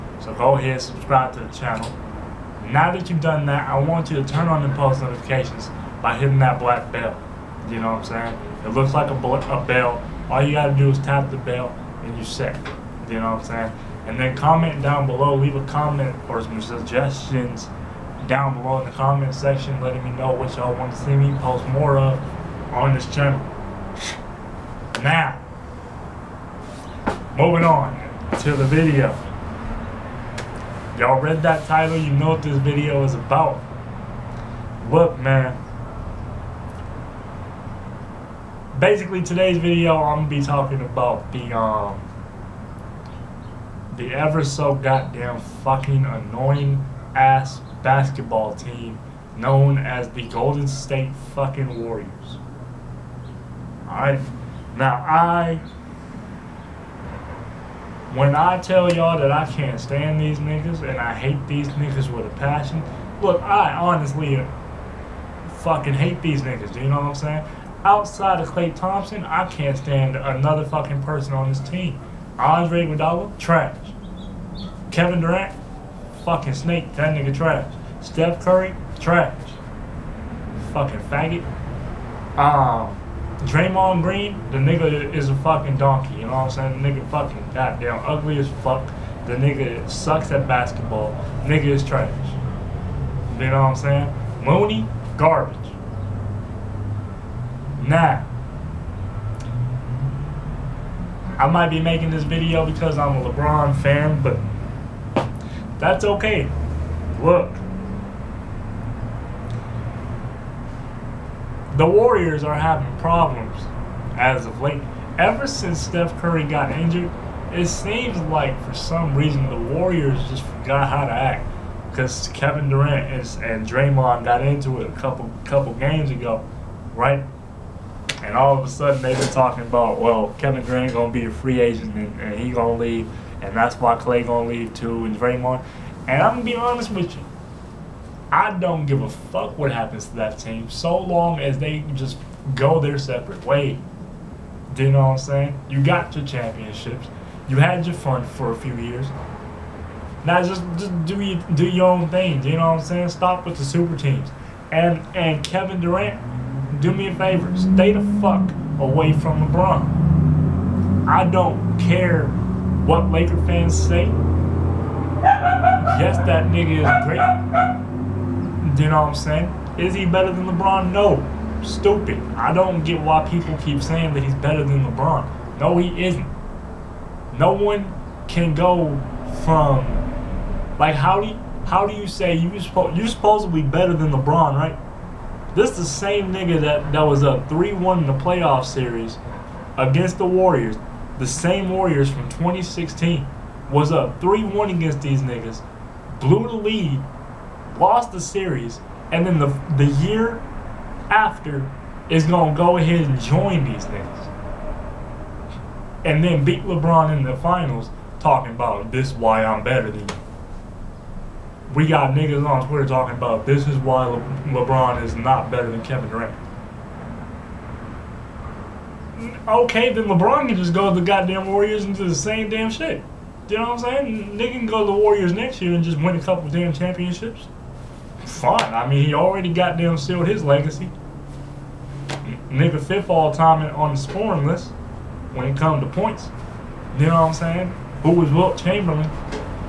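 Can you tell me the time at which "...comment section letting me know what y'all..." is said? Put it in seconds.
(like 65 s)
18 s.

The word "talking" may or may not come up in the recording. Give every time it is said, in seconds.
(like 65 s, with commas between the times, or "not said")
40 s, 129 s, 208 s, 212 s.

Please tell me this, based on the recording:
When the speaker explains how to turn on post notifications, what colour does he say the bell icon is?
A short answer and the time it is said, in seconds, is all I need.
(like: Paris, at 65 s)
black, at 6 s.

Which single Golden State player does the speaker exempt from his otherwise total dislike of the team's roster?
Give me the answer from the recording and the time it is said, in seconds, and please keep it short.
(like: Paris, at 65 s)
Klay Thompson, at 68 s.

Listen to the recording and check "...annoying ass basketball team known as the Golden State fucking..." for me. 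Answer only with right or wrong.
right.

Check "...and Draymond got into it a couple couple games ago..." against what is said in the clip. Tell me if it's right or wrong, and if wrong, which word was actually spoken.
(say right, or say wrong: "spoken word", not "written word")
right.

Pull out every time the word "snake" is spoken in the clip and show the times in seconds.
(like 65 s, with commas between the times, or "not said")
76 s.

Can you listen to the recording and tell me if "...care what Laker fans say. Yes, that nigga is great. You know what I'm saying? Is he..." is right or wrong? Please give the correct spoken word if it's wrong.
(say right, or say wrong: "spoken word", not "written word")
right.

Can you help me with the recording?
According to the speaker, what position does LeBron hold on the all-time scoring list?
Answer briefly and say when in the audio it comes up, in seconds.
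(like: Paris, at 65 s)
fifth, at 232 s.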